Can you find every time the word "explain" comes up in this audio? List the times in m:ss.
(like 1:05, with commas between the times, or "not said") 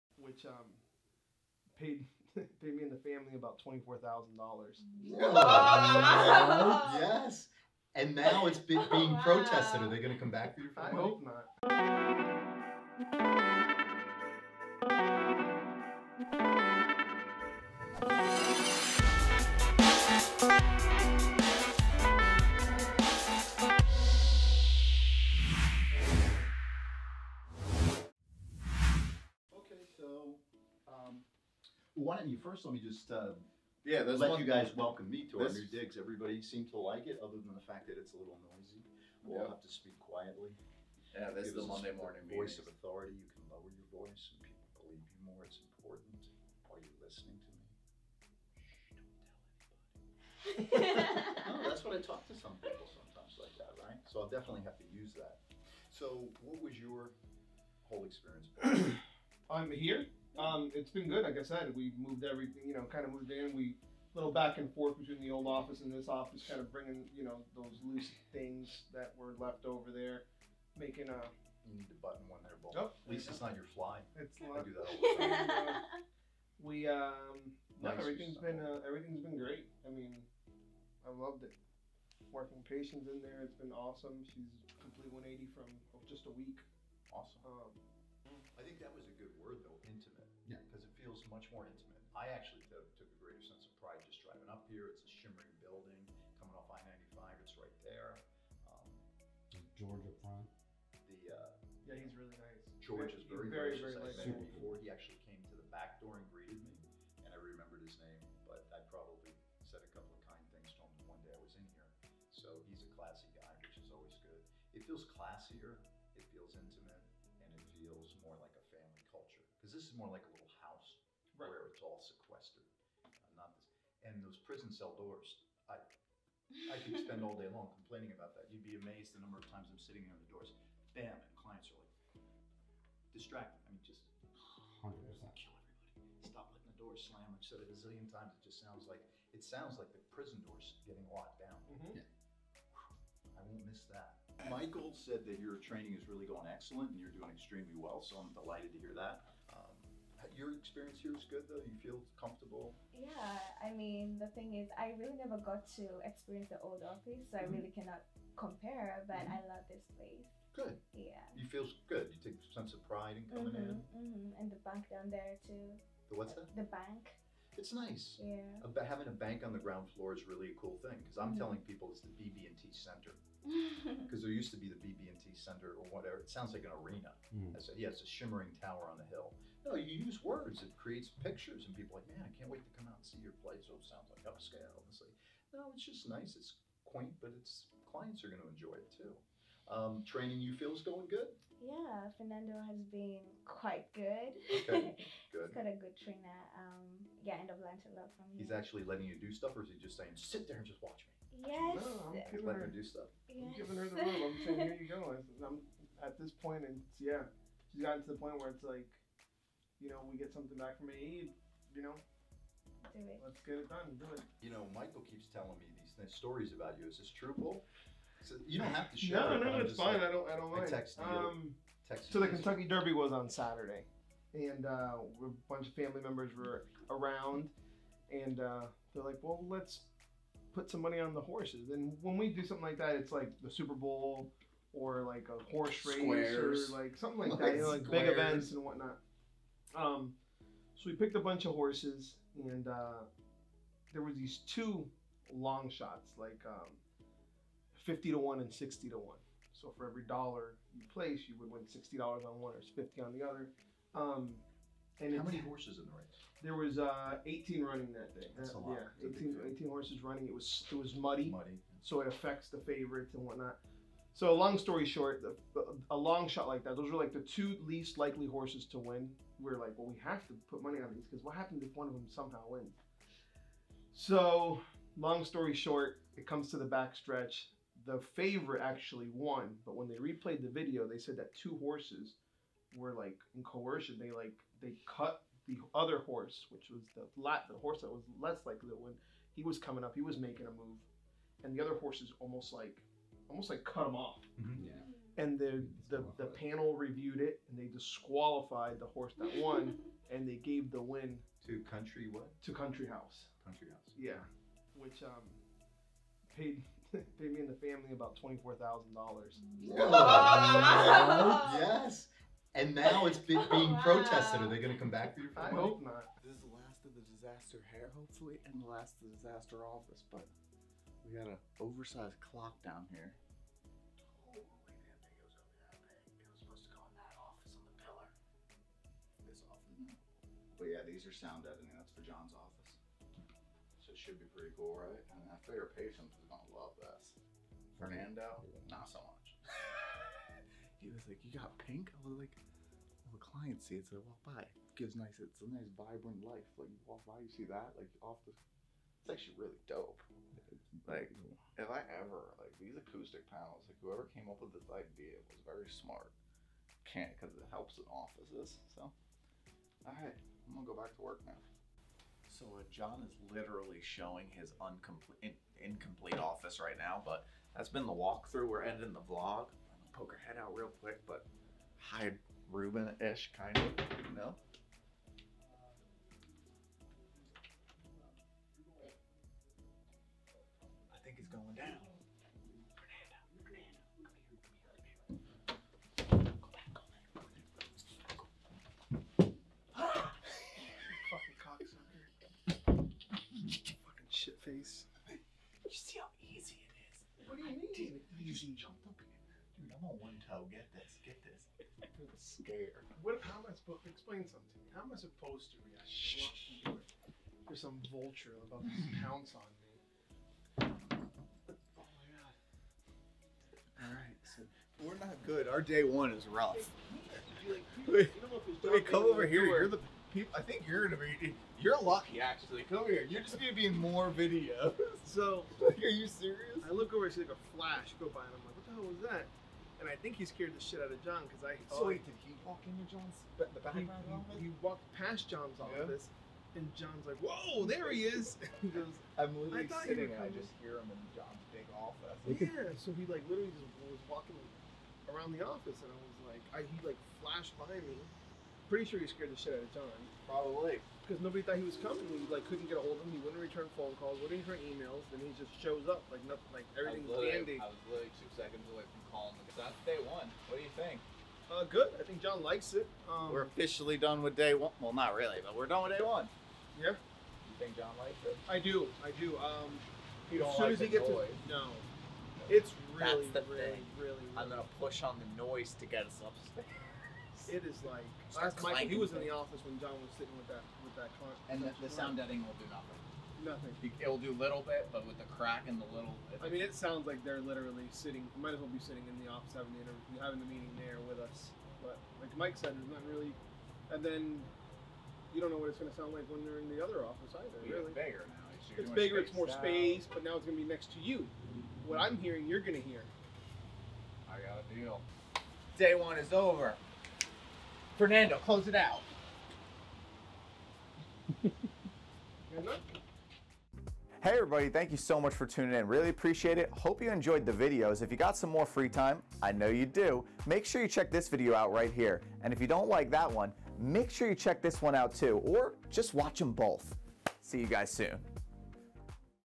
6:43.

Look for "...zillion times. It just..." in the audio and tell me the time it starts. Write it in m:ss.
2:17.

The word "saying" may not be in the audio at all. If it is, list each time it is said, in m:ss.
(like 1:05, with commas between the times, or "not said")
3:19, 3:24.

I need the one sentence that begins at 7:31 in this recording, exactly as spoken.
because nobody thought he was coming.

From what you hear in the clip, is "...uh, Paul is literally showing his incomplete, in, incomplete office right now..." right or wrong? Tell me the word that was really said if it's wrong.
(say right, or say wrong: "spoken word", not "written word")
wrong: "John", not "Paul".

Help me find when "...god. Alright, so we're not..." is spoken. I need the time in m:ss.
6:53.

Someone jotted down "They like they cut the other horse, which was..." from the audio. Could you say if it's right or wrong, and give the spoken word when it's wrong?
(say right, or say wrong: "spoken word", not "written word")
right.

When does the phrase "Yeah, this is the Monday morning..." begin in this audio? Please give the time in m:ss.
0:41.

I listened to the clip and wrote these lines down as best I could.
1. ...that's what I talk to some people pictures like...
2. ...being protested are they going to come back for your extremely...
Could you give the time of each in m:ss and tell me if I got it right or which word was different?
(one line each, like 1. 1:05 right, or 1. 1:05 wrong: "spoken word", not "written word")
1. 0:51 wrong: "sometimes", not "pictures"
2. 5:13 wrong: "family", not "extremely".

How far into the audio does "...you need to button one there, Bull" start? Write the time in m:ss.
1:11.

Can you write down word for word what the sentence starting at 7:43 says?
Um, We're officially done with day one.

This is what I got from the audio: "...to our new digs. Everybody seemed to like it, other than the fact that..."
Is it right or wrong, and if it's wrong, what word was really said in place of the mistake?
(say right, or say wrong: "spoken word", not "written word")
right.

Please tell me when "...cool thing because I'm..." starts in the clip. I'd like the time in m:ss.
2:50.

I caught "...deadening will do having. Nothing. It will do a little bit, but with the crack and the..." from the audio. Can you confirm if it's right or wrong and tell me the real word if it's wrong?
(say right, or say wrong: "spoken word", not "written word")
wrong: "nothing", not "having".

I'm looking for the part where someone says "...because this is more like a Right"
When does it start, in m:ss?
1:59.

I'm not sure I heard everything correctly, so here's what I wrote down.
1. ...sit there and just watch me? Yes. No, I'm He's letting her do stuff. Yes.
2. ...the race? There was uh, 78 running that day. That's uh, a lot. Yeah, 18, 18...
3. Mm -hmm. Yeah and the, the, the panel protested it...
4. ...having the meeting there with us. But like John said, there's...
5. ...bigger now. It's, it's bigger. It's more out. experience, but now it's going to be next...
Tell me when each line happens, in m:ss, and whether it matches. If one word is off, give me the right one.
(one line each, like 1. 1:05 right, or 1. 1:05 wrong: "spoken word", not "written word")
1. 3:20 right
2. 4:15 wrong: "18", not "78"
3. 4:54 wrong: "reviewed", not "protested"
4. 8:10 wrong: "Mike", not "John"
5. 8:17 wrong: "space", not "experience".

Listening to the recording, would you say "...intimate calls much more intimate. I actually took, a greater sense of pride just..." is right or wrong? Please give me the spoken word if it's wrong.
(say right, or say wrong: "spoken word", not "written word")
wrong: "feels", not "calls".